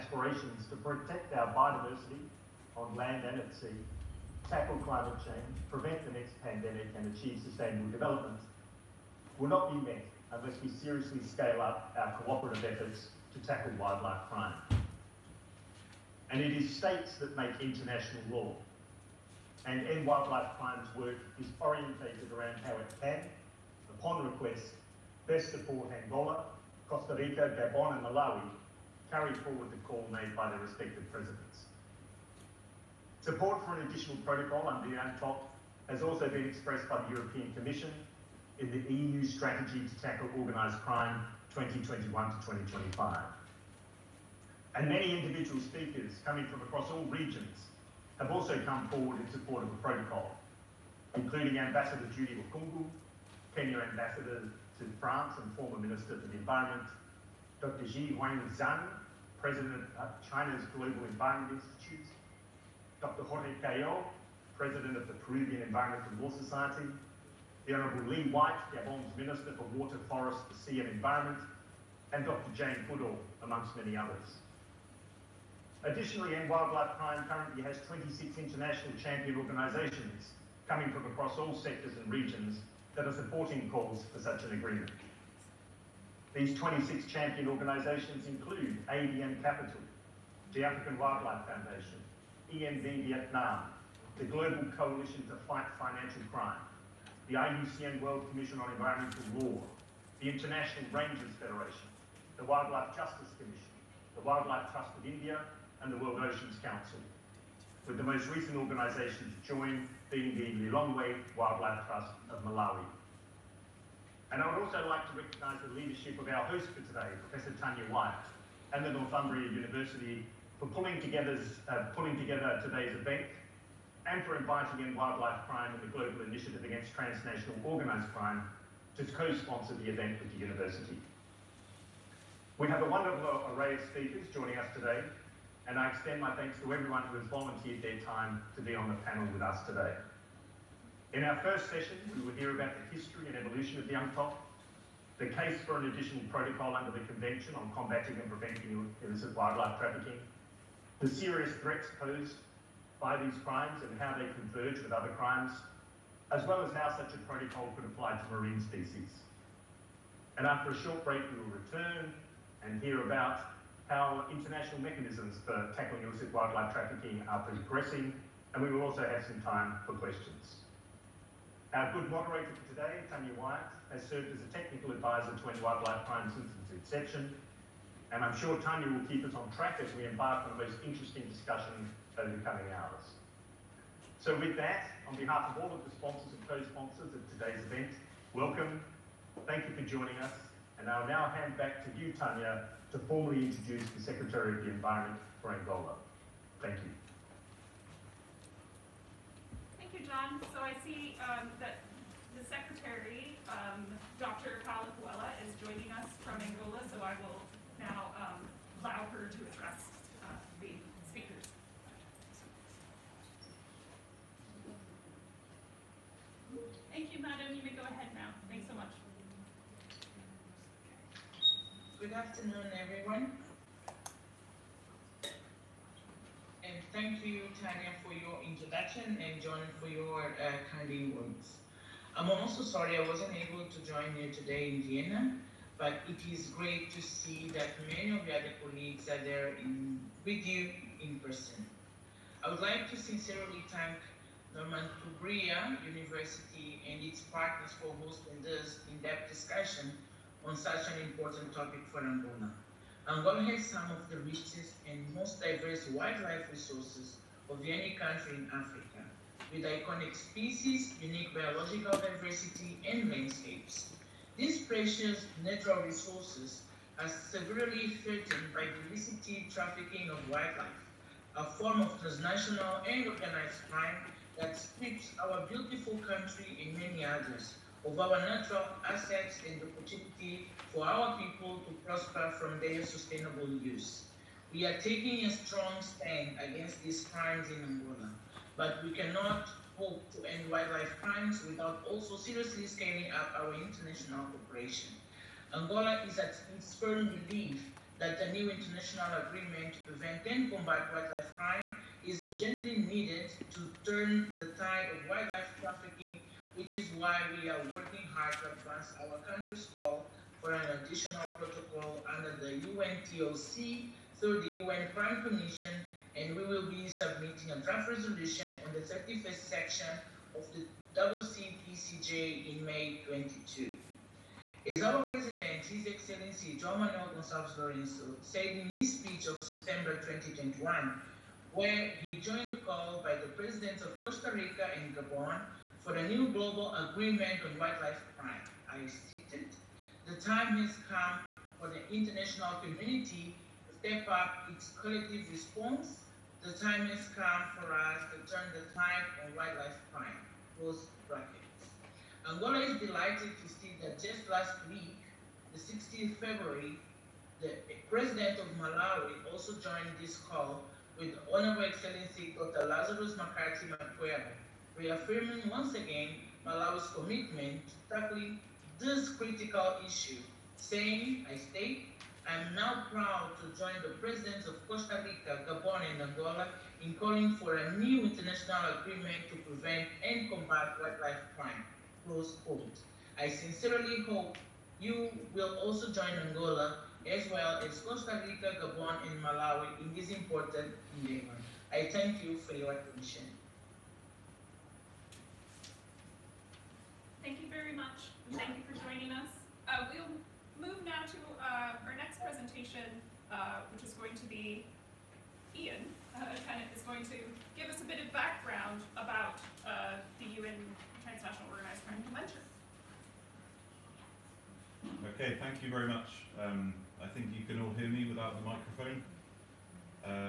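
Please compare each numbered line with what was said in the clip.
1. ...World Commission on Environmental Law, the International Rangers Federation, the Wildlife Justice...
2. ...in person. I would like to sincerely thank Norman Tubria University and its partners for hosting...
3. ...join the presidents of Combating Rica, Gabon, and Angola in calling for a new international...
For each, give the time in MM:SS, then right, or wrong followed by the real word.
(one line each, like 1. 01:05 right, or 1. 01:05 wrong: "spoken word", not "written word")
1. 01:38 right
2. 04:01 right
3. 06:13 wrong: "Costa", not "Combating".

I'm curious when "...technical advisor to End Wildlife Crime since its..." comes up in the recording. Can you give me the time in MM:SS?
02:54.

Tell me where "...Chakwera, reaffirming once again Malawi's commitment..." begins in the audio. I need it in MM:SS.
06:03.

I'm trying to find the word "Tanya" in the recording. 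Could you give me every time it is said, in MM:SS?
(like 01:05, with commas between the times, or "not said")
01:57, 02:53, 02:58, 03:12, 03:47.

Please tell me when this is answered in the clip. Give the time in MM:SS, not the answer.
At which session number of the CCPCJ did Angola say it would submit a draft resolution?
05:18.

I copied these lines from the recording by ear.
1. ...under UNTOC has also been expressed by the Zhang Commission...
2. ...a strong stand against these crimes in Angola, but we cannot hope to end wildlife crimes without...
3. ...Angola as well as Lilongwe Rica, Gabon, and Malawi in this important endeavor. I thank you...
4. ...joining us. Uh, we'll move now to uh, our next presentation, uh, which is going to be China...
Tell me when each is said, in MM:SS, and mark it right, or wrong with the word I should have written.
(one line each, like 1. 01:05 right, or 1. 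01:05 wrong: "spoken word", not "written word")
1. 00:34 wrong: "European", not "Zhang"
2. 04:45 right
3. 06:26 wrong: "Costa", not "Lilongwe"
4. 06:38 wrong: "Ian", not "China".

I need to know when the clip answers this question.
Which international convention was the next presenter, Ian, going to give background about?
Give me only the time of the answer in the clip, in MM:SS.
06:50.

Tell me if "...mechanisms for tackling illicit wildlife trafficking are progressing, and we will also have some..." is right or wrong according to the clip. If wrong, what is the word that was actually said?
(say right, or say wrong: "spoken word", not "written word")
right.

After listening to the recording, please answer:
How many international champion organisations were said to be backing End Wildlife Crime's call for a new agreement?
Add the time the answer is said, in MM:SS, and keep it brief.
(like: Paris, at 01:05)
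26, at 01:17.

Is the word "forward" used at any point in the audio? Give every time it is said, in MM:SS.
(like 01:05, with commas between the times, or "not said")
00:29, 00:48.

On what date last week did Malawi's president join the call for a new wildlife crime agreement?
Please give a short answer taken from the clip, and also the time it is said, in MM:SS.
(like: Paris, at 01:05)
16 February, at 05:55.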